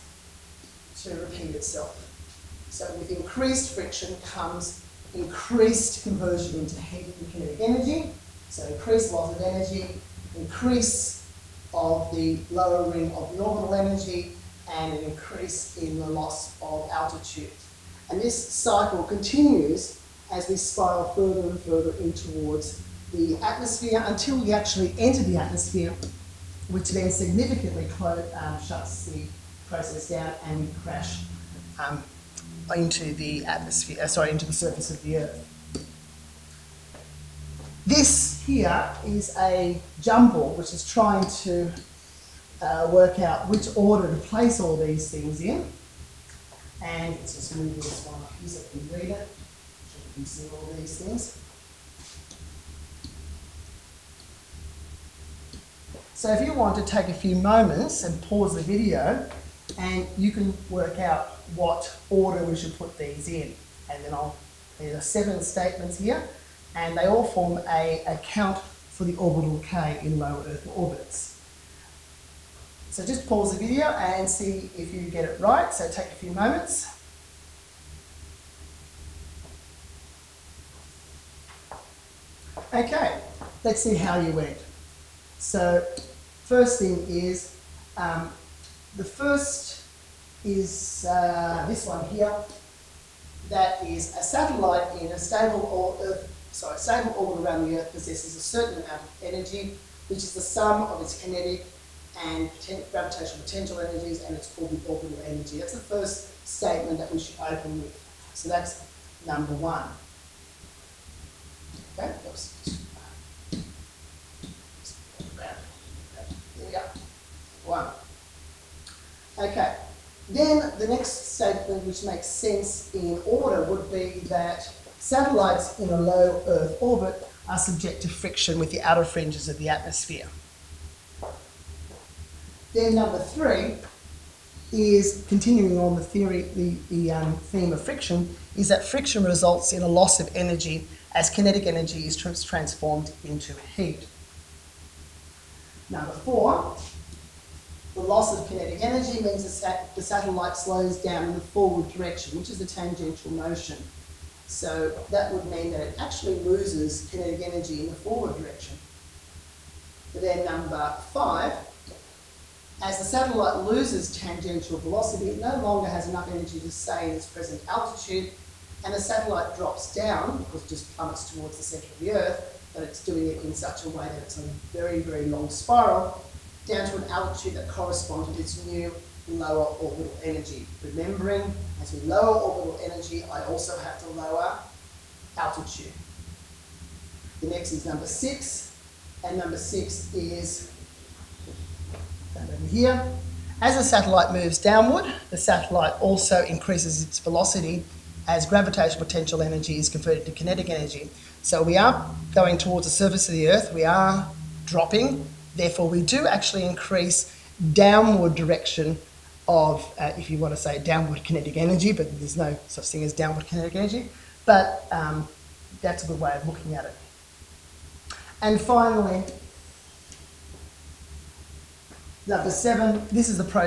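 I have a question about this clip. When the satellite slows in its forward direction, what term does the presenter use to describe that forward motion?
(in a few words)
tangential motion.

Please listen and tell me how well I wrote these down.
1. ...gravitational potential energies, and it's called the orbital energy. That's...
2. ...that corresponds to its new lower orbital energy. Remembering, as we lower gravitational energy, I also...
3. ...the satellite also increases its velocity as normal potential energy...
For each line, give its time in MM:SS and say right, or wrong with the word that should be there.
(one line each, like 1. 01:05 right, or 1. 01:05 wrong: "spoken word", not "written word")
1. 01:42 right
2. 02:57 wrong: "orbital", not "gravitational"
3. 03:15 wrong: "gravitational", not "normal".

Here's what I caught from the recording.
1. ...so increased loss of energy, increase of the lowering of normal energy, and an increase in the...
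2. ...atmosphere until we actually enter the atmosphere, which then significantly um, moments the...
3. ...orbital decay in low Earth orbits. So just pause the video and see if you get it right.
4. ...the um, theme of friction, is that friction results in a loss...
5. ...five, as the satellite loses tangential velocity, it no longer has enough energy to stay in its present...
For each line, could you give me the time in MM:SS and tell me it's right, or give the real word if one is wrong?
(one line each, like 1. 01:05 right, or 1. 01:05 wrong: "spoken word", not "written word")
1. 00:08 right
2. 00:23 wrong: "shuts", not "moments"
3. 01:09 right
4. 02:16 right
5. 02:41 right.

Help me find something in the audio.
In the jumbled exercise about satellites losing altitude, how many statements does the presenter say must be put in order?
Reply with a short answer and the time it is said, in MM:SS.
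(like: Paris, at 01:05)
7, at 01:05.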